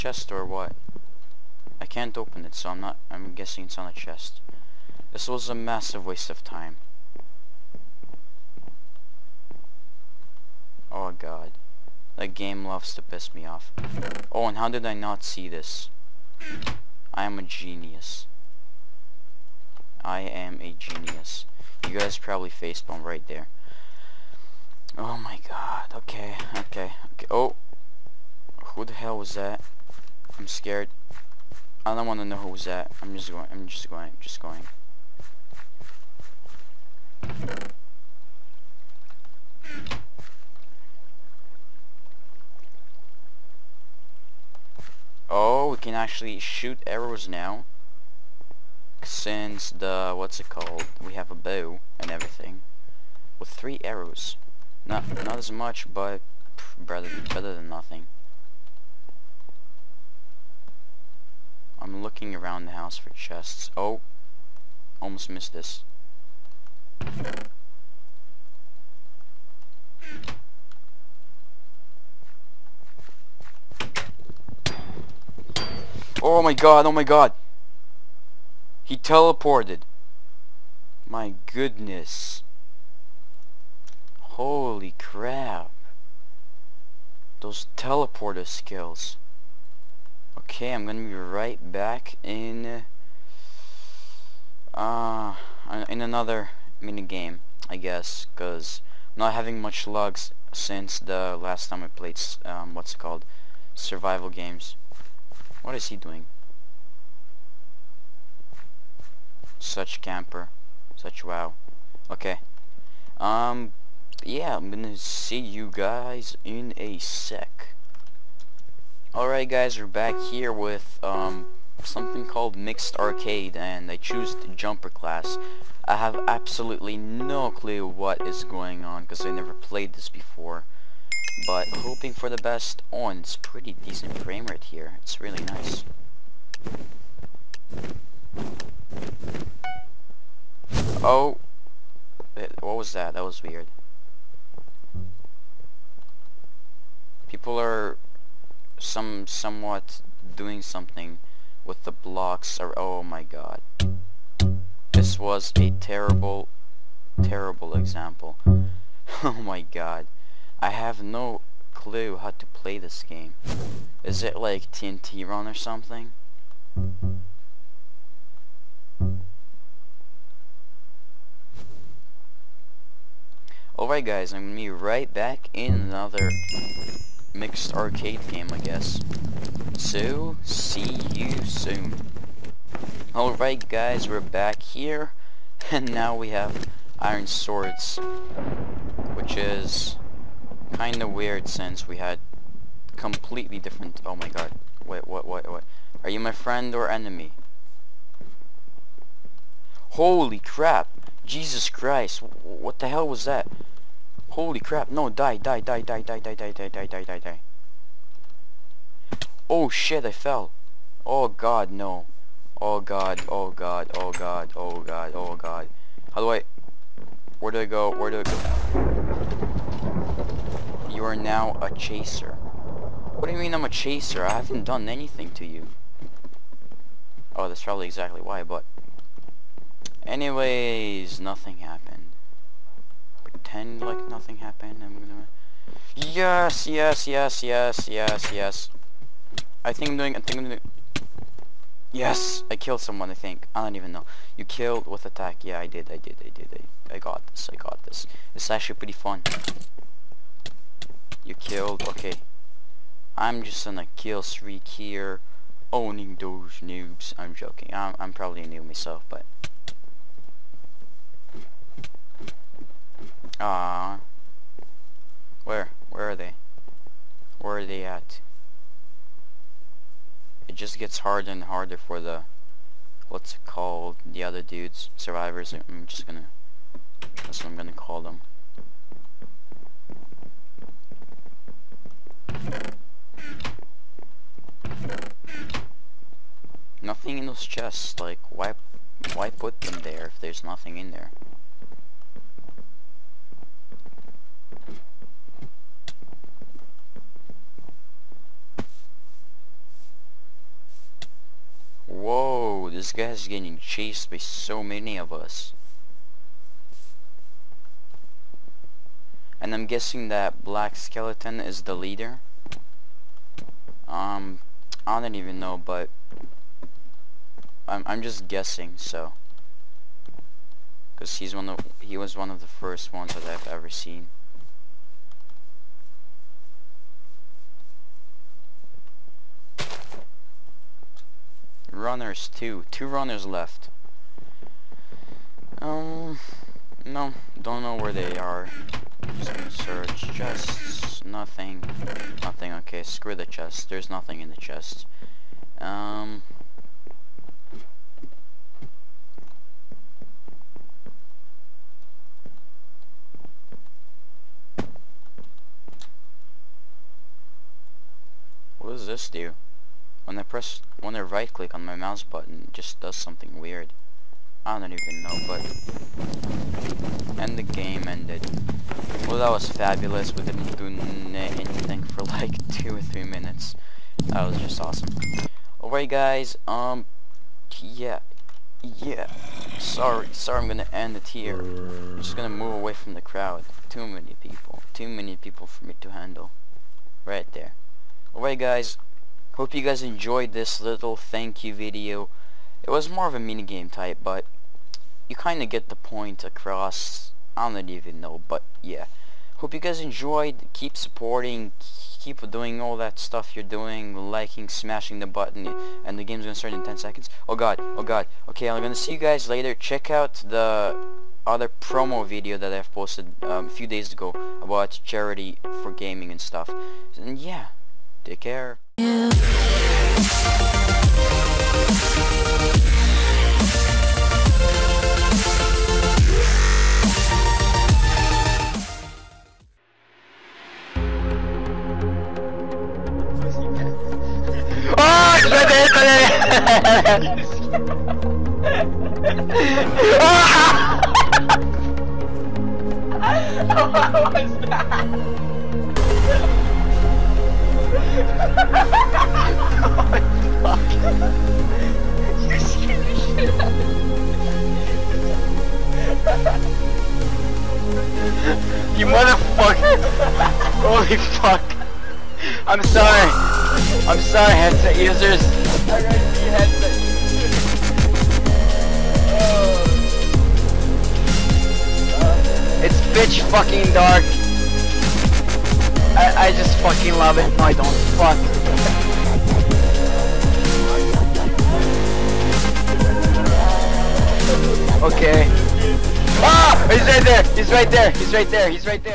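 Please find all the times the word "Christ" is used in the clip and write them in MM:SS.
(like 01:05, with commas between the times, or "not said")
03:21.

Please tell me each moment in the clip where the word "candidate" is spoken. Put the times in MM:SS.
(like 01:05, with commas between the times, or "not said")
not said.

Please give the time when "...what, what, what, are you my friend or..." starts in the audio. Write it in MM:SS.
03:15.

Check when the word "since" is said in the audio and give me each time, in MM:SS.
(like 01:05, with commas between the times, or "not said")
00:49, 01:40, 03:11.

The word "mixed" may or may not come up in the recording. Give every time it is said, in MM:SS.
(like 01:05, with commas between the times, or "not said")
02:02, 02:57.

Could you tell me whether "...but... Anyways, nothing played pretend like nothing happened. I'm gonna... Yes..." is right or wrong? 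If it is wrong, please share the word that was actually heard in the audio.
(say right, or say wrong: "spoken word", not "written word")
wrong: "happened", not "played".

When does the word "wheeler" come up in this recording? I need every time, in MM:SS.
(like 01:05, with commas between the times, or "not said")
not said.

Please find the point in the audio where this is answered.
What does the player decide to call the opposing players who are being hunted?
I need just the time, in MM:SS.
04:34.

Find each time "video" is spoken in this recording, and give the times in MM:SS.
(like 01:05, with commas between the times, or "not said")
06:31, 06:52.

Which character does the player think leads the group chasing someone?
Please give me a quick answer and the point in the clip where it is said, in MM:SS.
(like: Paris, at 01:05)
Black Skeleton, at 05:10.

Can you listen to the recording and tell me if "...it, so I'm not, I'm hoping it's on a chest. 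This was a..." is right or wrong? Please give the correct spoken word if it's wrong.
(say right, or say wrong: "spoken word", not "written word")
wrong: "guessing", not "hoping".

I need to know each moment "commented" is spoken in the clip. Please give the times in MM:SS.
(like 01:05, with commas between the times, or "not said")
not said.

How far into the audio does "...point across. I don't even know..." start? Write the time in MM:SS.
06:35.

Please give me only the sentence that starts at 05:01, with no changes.
Whoa, this guy's getting chased by so many of us.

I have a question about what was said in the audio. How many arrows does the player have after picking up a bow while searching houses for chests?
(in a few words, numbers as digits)
3.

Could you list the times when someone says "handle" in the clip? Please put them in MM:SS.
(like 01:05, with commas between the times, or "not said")
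06:25.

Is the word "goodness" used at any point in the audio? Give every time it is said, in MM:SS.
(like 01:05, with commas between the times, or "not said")
01:21.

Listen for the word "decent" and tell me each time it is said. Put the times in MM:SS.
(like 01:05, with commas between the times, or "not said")
02:13.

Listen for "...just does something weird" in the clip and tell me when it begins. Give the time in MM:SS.
06:02.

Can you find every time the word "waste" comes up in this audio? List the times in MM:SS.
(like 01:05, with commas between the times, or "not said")
00:06.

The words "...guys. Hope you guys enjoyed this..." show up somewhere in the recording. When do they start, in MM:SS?
06:28.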